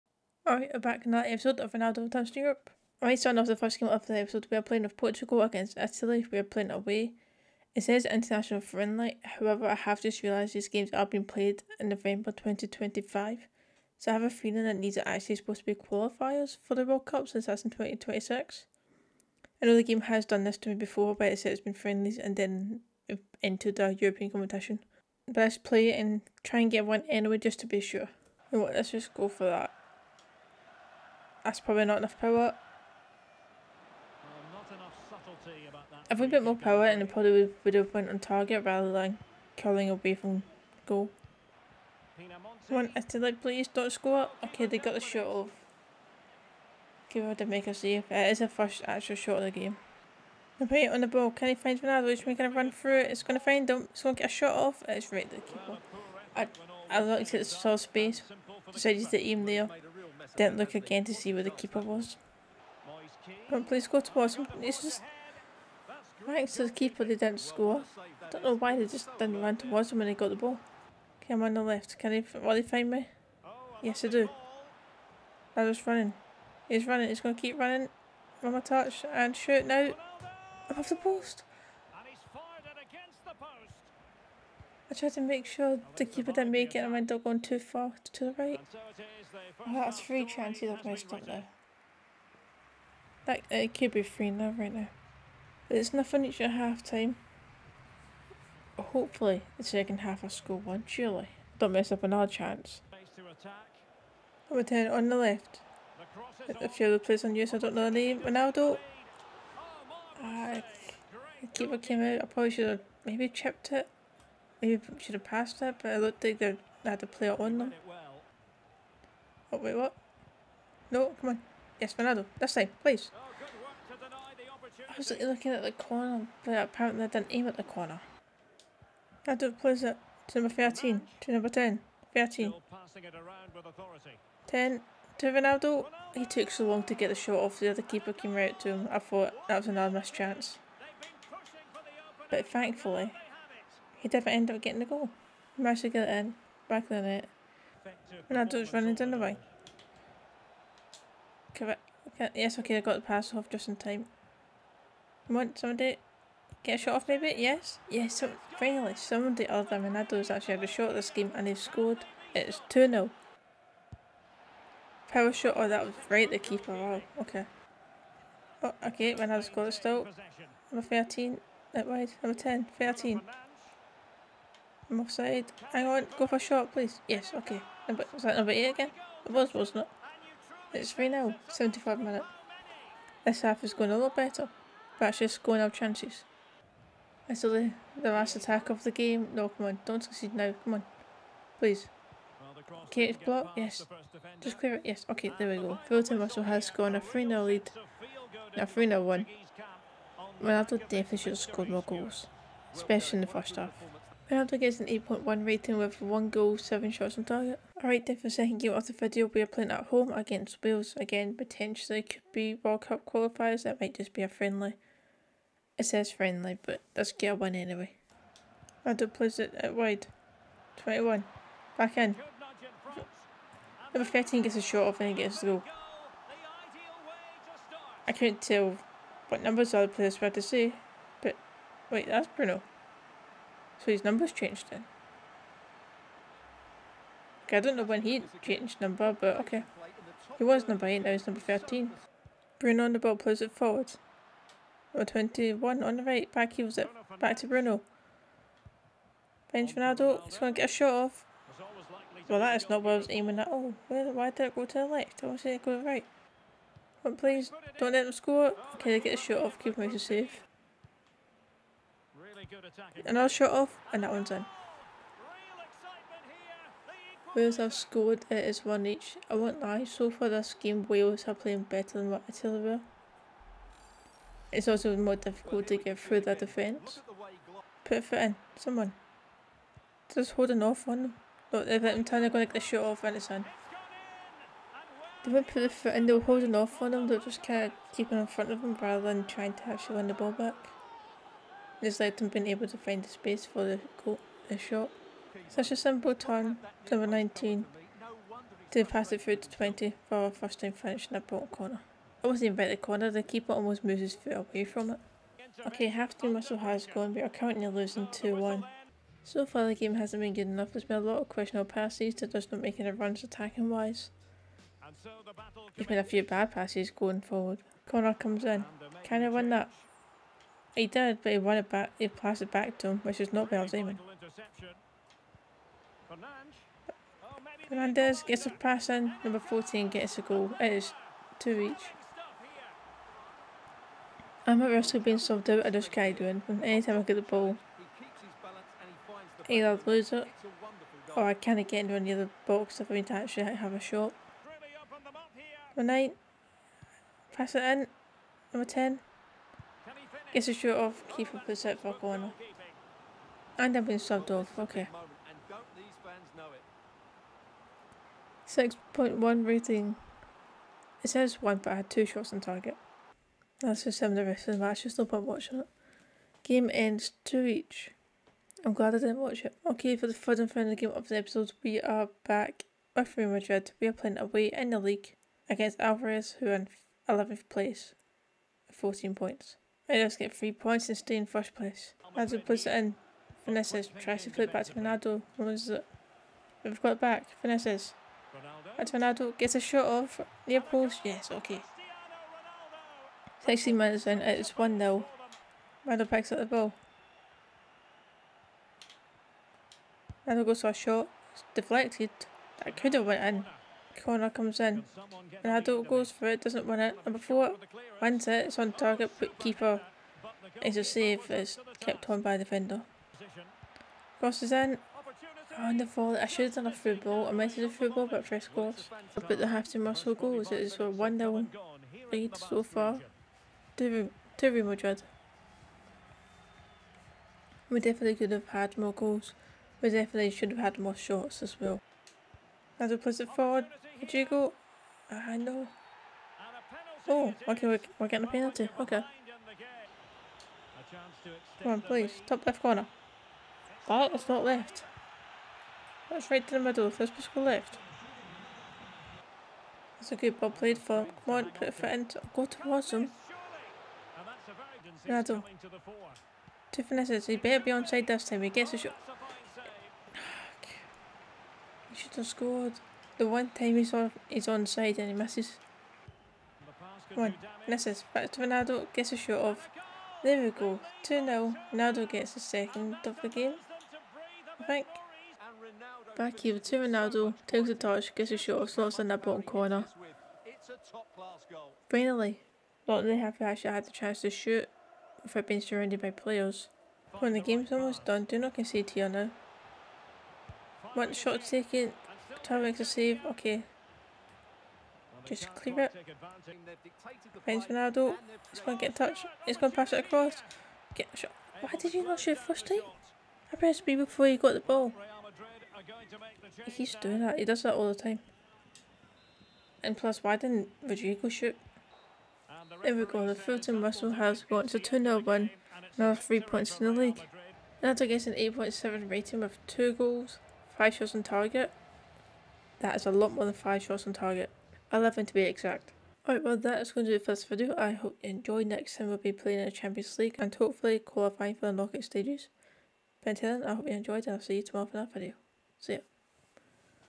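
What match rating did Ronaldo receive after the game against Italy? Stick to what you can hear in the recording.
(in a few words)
8.1.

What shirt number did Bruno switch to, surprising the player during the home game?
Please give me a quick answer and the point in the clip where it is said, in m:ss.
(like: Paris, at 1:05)
13, at 4:00.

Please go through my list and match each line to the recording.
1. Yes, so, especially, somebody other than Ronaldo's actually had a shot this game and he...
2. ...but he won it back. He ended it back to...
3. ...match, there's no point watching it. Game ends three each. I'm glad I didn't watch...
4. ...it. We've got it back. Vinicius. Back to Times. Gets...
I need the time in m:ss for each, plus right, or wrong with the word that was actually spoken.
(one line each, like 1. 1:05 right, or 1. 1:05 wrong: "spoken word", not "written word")
1. 2:37 wrong: "finally", not "especially"
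2. 5:21 wrong: "passed", not "ended"
3. 6:04 wrong: "two", not "three"
4. 6:25 wrong: "Ronaldo", not "Times".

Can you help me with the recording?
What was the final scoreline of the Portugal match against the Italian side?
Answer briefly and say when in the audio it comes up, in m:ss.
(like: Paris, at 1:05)
3-1, at 3:18.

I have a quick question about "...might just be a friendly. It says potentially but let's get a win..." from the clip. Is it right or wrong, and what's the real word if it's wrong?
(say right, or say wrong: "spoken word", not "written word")
wrong: "friendly", not "potentially".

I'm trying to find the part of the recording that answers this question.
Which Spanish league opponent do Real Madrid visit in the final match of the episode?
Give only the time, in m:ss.
6:15.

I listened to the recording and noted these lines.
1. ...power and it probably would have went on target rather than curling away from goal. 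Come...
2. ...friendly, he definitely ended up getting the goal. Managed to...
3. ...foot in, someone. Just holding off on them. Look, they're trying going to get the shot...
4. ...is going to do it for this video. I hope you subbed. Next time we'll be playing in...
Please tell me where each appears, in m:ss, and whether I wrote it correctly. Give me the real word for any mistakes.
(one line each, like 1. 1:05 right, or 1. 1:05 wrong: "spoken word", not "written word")
1. 0:36 right
2. 2:22 wrong: "thankfully", not "friendly"
3. 4:38 right
4. 8:46 wrong: "enjoyed", not "subbed".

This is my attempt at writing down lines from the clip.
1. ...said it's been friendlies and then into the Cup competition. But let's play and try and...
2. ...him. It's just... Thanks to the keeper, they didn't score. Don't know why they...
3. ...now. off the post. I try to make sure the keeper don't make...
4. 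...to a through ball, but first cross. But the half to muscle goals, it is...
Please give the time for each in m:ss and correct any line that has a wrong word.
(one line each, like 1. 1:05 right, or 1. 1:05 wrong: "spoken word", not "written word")
1. 0:21 wrong: "European", not "Cup"
2. 1:04 right
3. 1:19 right
4. 6:57 right.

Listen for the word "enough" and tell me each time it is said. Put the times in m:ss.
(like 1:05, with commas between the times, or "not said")
0:31, 5:10.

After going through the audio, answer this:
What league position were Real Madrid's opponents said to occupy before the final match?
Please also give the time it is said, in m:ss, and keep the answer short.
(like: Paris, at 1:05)
11th, at 6:17.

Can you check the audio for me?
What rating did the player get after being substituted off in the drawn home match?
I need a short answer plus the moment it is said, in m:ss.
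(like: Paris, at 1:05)
6.1, at 5:58.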